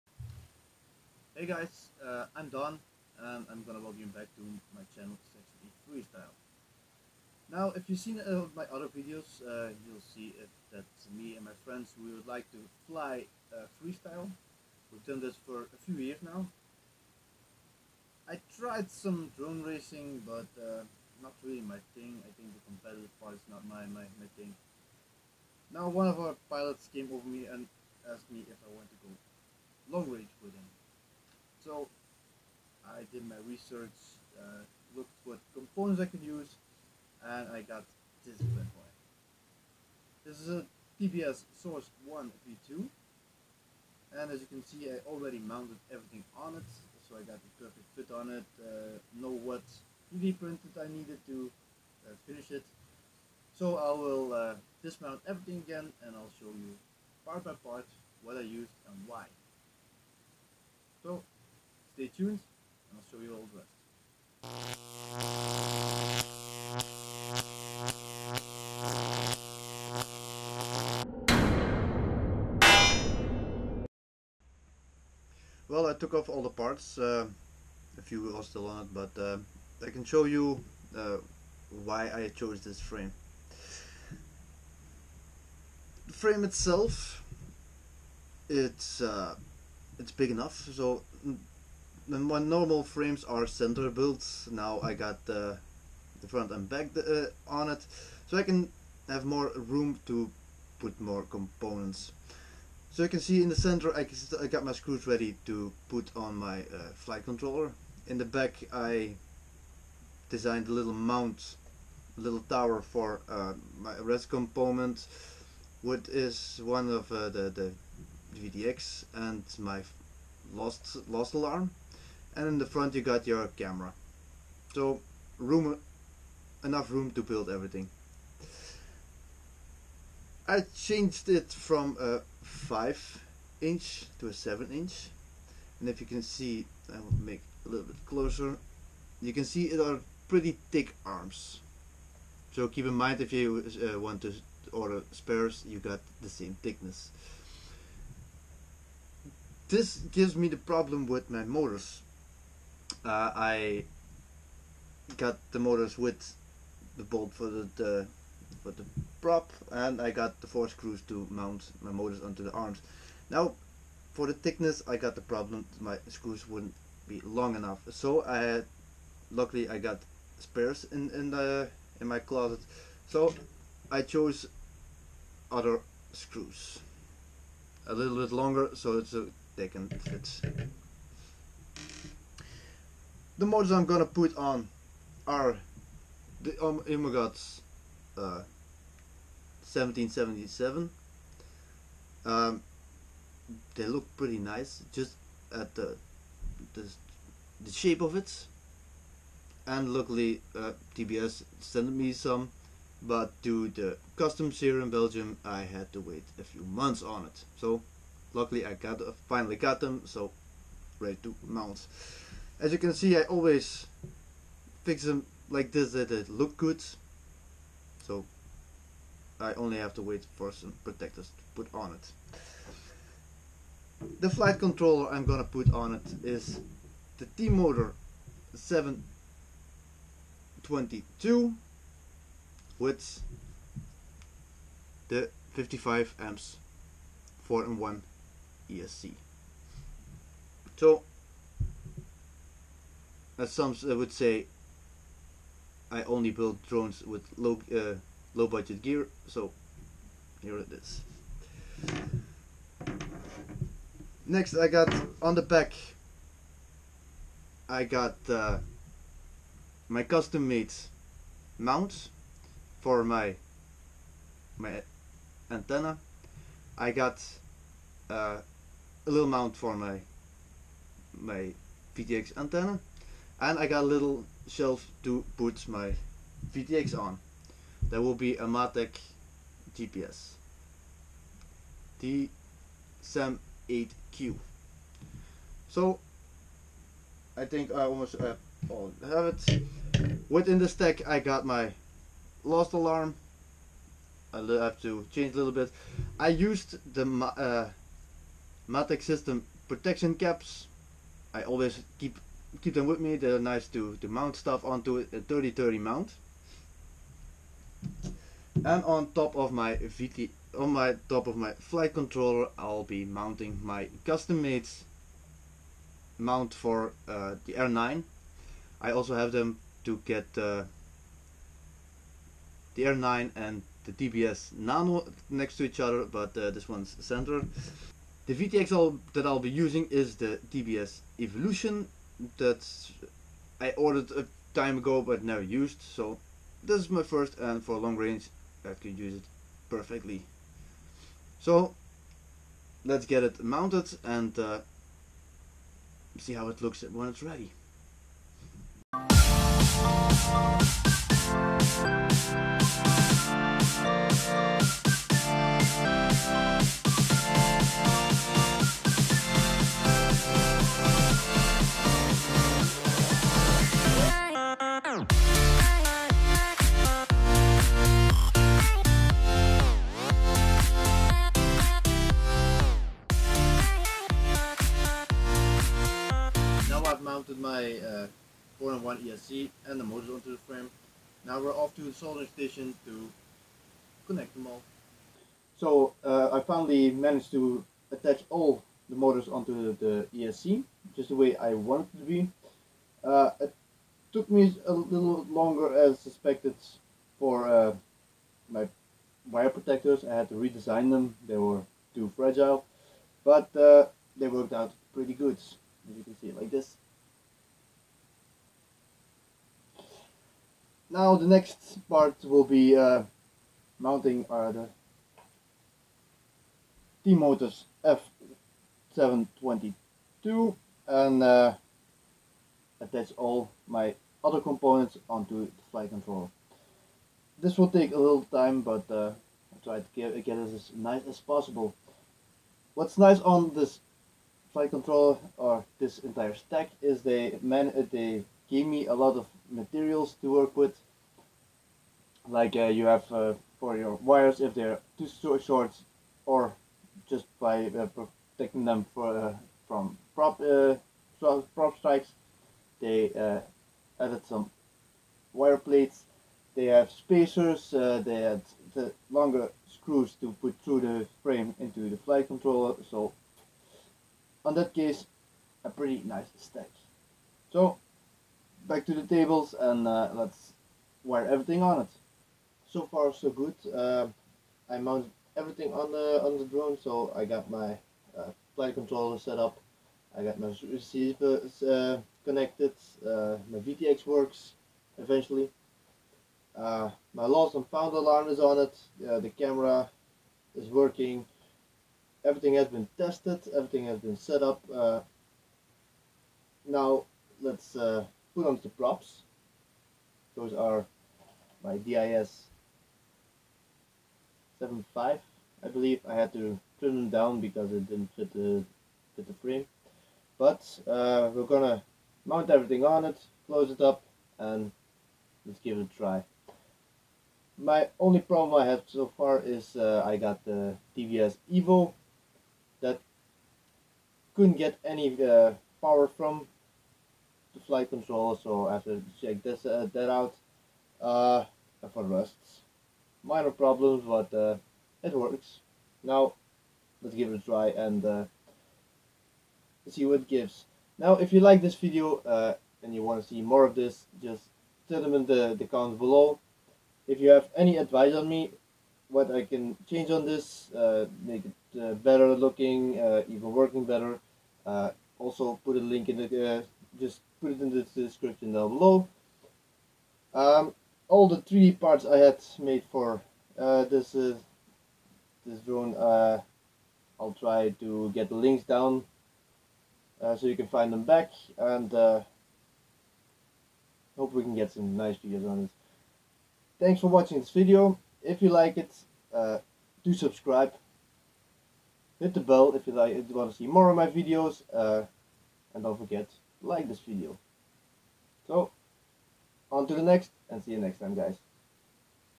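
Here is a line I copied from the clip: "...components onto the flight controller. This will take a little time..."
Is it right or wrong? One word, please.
right.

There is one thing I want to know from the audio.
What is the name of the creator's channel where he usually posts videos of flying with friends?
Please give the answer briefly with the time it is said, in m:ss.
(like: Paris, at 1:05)
Section E Freestyle, at 0:05.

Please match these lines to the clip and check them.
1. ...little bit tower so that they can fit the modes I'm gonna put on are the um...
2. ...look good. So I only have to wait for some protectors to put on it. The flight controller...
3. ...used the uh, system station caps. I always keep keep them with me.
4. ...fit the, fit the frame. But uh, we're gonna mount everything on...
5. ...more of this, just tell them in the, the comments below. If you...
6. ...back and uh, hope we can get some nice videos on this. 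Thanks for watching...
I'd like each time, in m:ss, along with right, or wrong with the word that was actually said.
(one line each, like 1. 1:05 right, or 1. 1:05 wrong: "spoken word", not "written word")
1. 2:57 wrong: "longer", not "tower"
2. 3:36 right
3. 4:56 wrong: "protection", not "station"
4. 8:28 right
5. 9:03 right
6. 9:31 right.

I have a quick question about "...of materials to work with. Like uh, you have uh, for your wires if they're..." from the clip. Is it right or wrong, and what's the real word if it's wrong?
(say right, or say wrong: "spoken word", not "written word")
right.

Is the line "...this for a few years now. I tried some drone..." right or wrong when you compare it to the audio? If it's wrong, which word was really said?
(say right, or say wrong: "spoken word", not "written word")
right.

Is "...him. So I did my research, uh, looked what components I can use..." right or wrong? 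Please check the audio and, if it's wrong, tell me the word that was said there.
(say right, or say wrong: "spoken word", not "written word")
right.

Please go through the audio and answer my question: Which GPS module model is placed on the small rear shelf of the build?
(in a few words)
SAM8Q.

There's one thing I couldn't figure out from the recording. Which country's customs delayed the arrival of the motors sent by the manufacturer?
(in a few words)
Belgium.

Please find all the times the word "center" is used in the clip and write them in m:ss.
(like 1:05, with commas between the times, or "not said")
1:33, 1:43, 5:26.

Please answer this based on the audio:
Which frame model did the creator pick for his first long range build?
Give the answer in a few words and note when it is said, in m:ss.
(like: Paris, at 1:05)
TBS Source 1 V2, at 0:40.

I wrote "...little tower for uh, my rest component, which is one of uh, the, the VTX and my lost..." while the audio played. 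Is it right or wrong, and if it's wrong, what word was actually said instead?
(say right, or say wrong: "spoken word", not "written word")
right.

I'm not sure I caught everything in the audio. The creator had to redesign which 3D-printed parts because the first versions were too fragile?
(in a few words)
wire protectors.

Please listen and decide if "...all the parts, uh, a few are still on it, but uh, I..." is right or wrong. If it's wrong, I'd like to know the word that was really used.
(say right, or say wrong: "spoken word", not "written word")
right.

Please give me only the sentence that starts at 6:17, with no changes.
mounted my uh, 4 in 1 ESC and the motors onto the frame.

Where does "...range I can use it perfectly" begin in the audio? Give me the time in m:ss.
5:37.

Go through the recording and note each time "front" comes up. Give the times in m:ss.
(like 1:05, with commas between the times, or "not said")
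1:36, 2:02.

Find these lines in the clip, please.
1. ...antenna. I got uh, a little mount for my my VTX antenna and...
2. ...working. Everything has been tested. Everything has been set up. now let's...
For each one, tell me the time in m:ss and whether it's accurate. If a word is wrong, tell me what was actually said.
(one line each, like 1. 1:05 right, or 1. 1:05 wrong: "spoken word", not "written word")
1. 4:25 right
2. 8:10 right.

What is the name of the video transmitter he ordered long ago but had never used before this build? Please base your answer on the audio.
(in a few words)
TBS Evolution.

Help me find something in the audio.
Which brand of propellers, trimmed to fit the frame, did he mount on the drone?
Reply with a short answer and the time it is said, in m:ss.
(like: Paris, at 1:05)
DYS, at 8:21.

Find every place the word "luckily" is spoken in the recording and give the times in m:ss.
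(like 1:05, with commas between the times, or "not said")
2:49, 3:19, 3:28.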